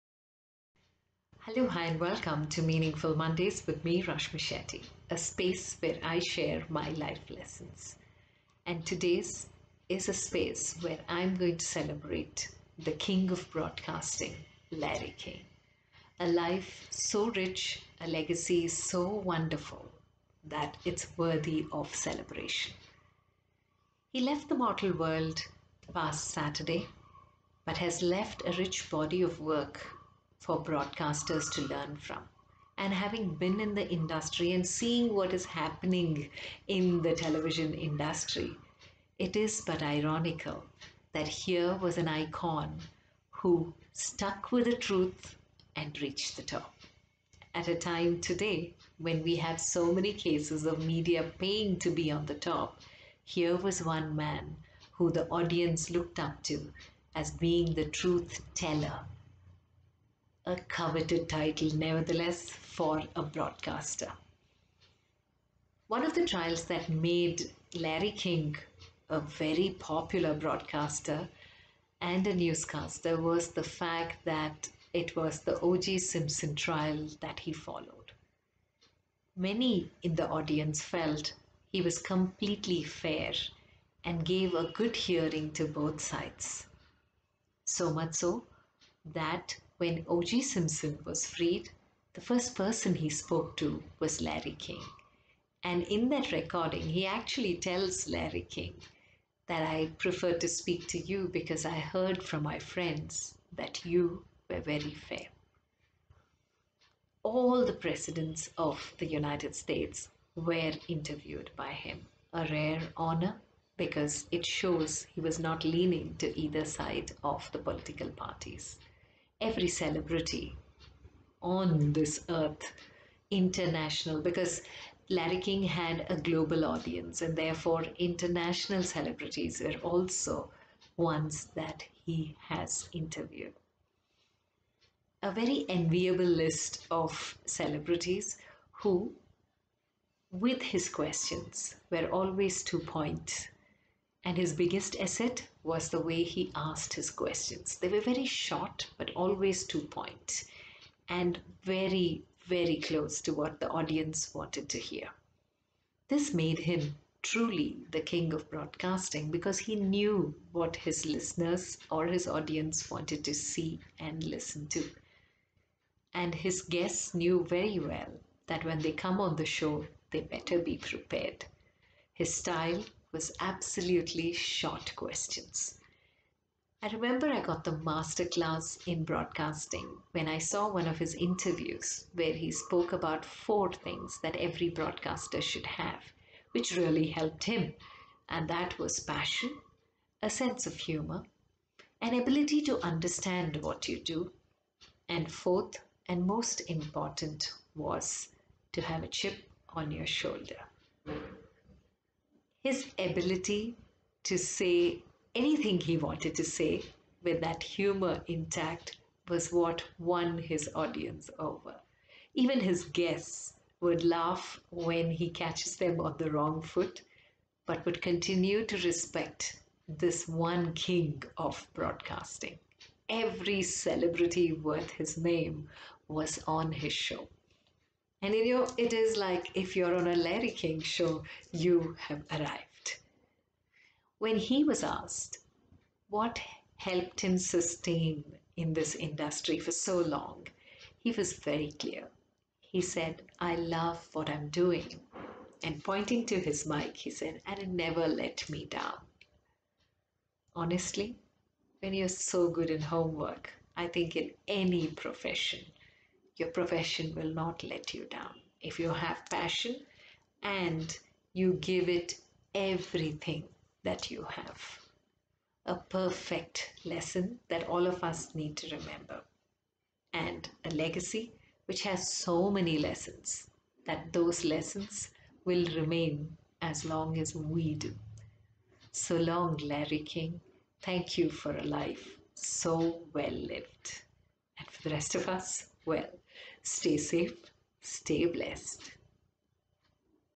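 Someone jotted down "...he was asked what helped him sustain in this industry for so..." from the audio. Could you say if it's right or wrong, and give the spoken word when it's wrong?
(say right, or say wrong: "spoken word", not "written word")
right.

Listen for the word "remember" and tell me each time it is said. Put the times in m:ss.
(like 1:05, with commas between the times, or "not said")
2:56, 4:28.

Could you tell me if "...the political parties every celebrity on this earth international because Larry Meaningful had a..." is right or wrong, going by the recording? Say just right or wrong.
wrong.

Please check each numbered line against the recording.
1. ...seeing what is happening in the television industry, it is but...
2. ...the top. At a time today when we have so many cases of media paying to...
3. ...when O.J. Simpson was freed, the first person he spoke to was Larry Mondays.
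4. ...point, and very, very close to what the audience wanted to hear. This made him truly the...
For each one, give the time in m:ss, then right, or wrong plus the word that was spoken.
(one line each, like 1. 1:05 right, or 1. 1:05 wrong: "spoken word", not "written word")
1. 0:34 right
2. 0:46 right
3. 1:29 wrong: "King", not "Mondays"
4. 2:29 right.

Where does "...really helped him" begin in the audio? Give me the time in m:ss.
3:06.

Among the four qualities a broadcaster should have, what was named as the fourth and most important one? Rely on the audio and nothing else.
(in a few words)
A chip on your shoulder.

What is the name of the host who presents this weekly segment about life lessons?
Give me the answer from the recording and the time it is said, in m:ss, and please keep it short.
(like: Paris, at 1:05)
Rashmi Shetty, at 0:04.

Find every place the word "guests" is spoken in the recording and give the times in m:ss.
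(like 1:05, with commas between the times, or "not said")
2:46, 3:32.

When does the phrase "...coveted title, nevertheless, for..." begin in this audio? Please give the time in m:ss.
1:00.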